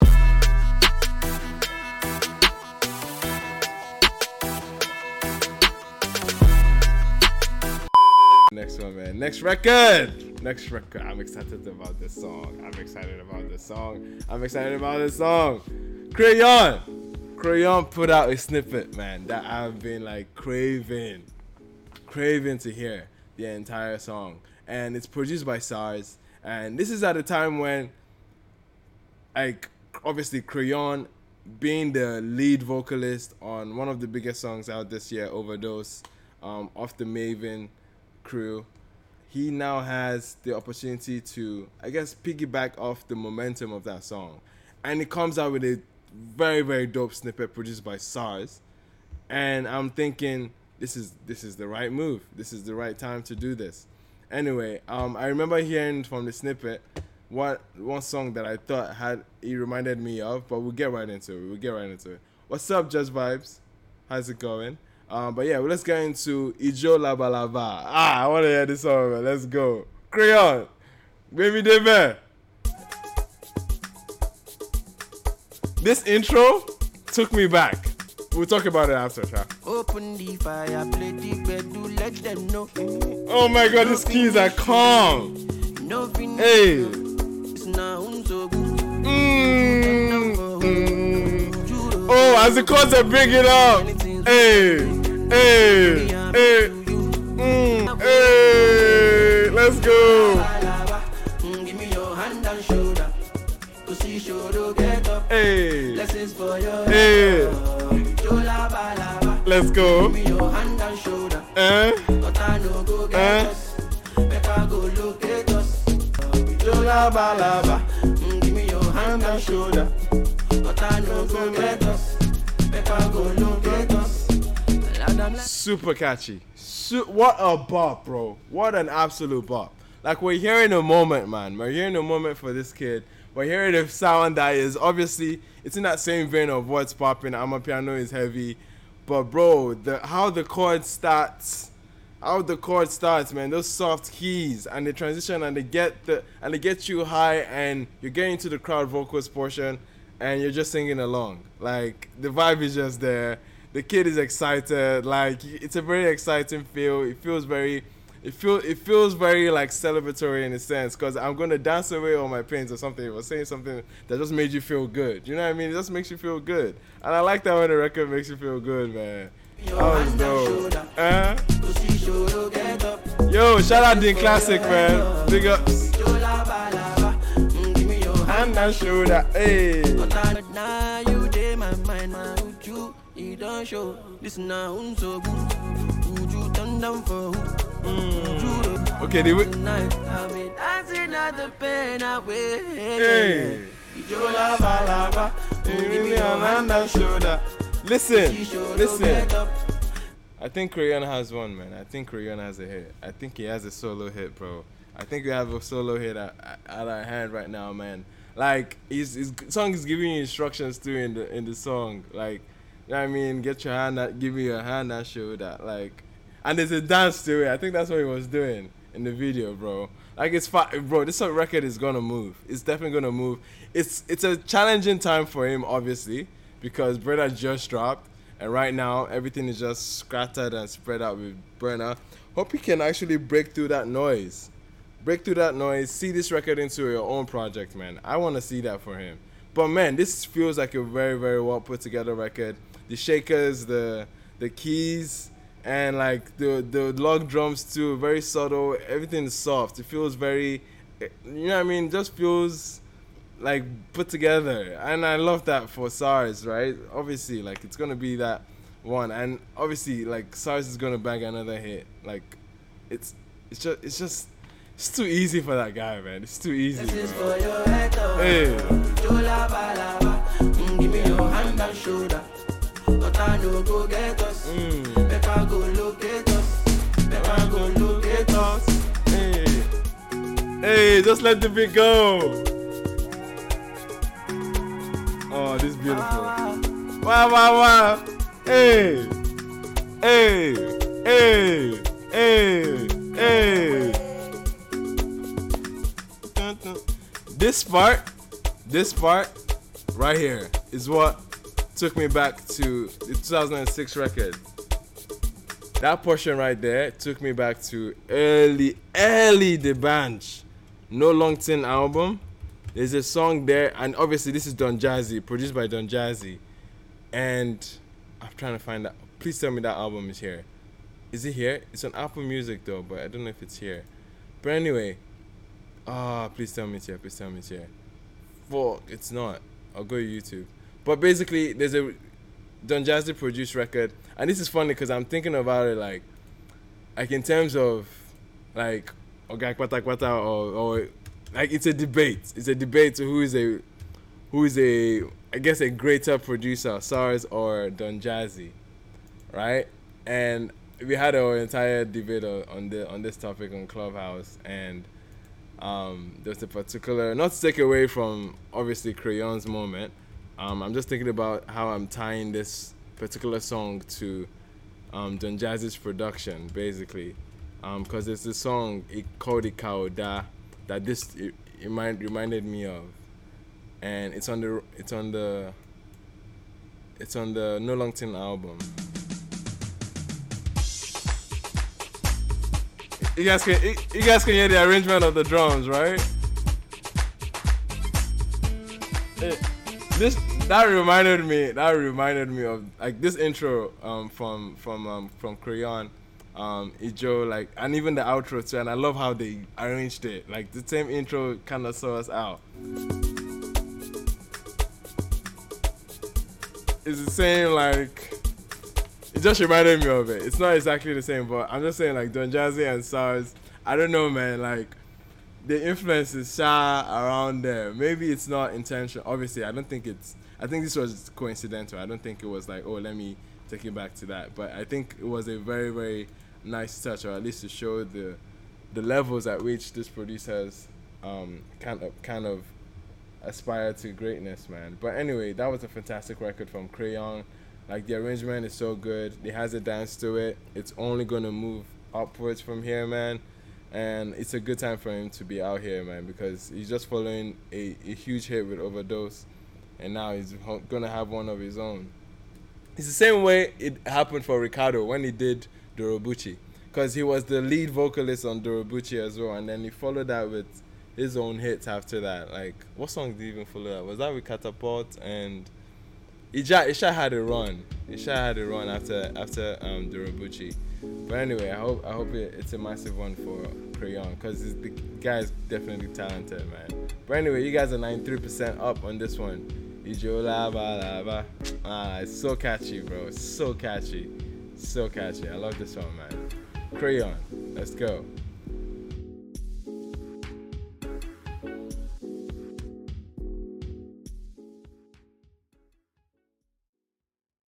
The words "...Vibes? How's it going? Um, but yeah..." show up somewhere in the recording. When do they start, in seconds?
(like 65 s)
63 s.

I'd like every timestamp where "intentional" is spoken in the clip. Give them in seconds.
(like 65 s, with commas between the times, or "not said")
418 s.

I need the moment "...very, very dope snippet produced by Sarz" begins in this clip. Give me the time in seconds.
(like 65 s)
46 s.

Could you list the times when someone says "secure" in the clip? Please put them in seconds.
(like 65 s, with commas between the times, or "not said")
not said.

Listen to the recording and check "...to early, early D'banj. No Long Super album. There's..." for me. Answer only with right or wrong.
wrong.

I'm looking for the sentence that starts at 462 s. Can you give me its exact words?
Like, what song did he even follow that?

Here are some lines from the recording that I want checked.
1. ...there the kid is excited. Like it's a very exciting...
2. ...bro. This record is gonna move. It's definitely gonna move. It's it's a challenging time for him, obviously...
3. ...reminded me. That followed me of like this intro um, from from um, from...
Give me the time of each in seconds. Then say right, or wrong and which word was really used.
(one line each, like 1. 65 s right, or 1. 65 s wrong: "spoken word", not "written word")
1. 153 s right
2. 220 s right
3. 390 s wrong: "reminded", not "followed".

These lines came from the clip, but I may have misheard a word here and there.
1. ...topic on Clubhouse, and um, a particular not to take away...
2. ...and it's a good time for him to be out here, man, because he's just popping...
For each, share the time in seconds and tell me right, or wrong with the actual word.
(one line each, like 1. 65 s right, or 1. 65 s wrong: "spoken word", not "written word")
1. 353 s right
2. 443 s wrong: "following", not "popping".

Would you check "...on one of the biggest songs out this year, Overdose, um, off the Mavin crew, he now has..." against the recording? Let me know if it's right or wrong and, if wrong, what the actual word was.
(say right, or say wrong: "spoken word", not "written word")
right.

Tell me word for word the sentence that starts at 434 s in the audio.
But anyway, that was a fantastic record from Crayon.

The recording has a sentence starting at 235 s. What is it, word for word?
See this record into your own project, man.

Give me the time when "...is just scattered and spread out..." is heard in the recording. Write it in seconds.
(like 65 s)
229 s.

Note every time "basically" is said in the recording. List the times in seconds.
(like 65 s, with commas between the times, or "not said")
330 s, 366 s.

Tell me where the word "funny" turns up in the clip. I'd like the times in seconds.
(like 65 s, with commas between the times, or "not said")
334 s.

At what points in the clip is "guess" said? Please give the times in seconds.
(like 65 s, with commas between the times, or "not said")
41 s, 345 s.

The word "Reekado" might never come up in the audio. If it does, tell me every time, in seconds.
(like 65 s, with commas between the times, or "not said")
454 s.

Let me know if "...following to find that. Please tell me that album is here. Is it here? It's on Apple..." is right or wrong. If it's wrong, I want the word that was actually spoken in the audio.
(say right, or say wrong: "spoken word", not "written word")
wrong: "trying", not "following".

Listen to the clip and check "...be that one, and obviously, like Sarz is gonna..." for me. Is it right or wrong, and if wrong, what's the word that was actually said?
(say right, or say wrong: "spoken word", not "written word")
right.